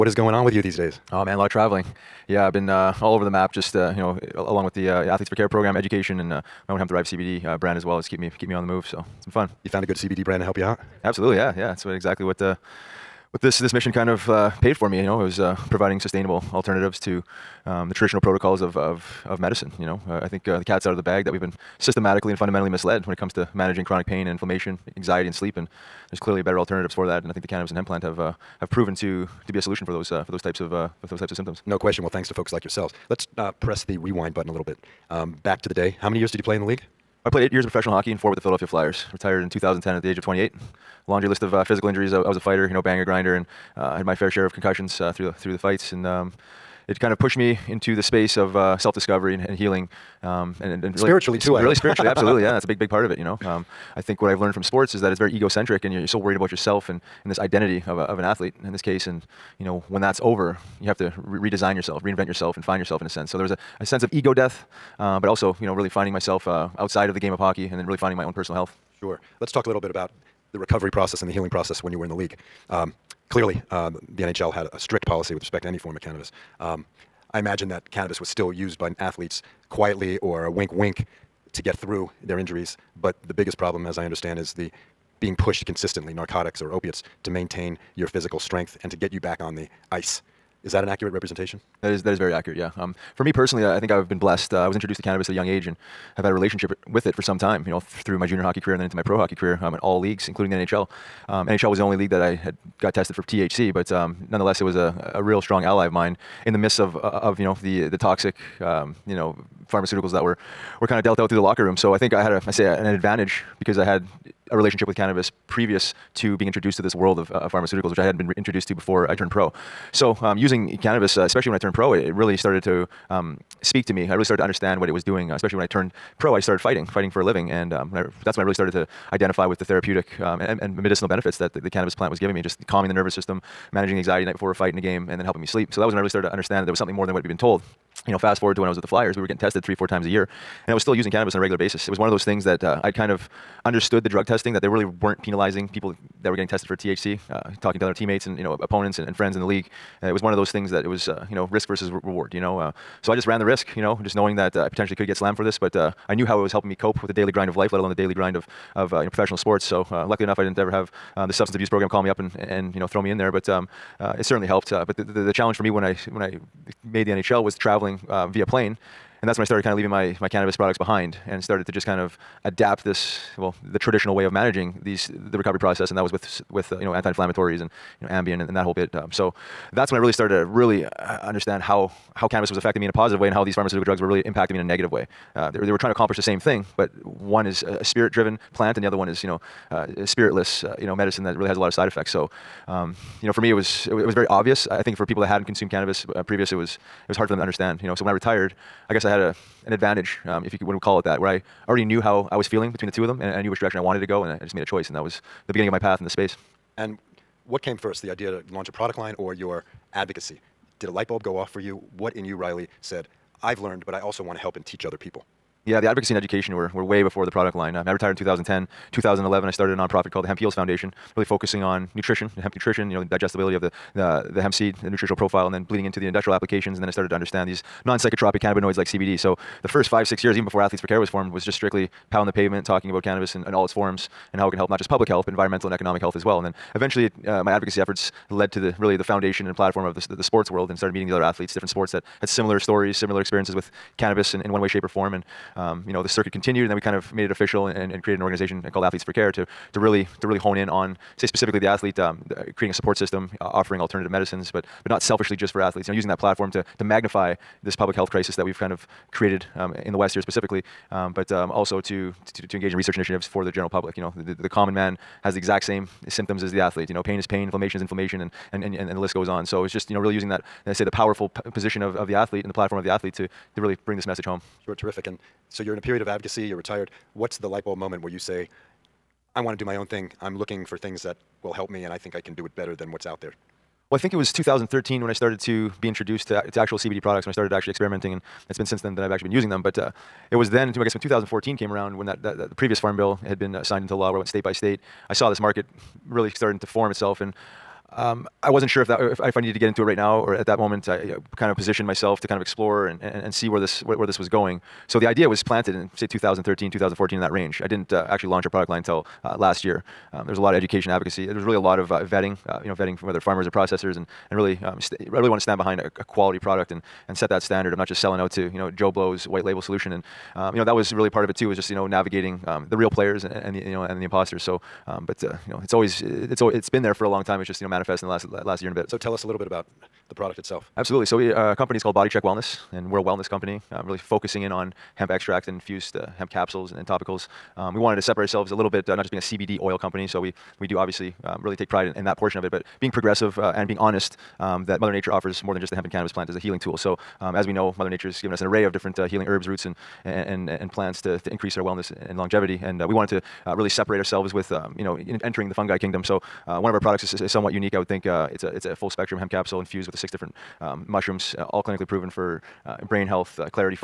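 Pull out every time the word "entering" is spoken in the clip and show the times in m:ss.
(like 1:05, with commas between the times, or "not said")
5:55.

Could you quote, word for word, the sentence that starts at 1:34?
Uh, I was introduced to cannabis at a young age and have had a relationship with it for some time.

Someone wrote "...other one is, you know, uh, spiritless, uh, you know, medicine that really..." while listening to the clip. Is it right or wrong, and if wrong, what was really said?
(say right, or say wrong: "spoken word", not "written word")
right.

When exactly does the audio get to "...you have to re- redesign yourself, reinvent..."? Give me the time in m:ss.
1:00.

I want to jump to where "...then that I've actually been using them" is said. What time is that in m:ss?
4:48.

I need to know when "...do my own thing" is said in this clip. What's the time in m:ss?
4:39.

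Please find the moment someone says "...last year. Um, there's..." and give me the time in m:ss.
5:09.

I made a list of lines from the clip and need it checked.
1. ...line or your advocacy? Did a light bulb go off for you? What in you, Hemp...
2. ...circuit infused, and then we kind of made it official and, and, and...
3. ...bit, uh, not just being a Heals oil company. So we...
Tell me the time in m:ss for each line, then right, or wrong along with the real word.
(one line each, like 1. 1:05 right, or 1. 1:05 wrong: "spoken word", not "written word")
1. 3:28 wrong: "Riley", not "Hemp"
2. 4:06 wrong: "continued", not "infused"
3. 5:38 wrong: "CBD", not "Heals".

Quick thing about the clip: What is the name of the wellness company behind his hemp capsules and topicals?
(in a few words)
BodyChek Wellness.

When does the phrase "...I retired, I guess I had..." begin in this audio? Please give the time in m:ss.
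3:18.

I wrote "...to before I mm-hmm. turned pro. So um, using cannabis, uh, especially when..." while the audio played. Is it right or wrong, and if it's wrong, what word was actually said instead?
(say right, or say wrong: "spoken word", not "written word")
right.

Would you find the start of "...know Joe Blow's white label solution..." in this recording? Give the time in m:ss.
5:18.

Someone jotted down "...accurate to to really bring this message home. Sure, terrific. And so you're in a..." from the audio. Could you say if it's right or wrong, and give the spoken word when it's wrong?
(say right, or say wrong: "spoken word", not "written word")
wrong: "athlete", not "accurate".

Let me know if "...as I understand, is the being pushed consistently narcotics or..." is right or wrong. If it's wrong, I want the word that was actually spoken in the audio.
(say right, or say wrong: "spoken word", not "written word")
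right.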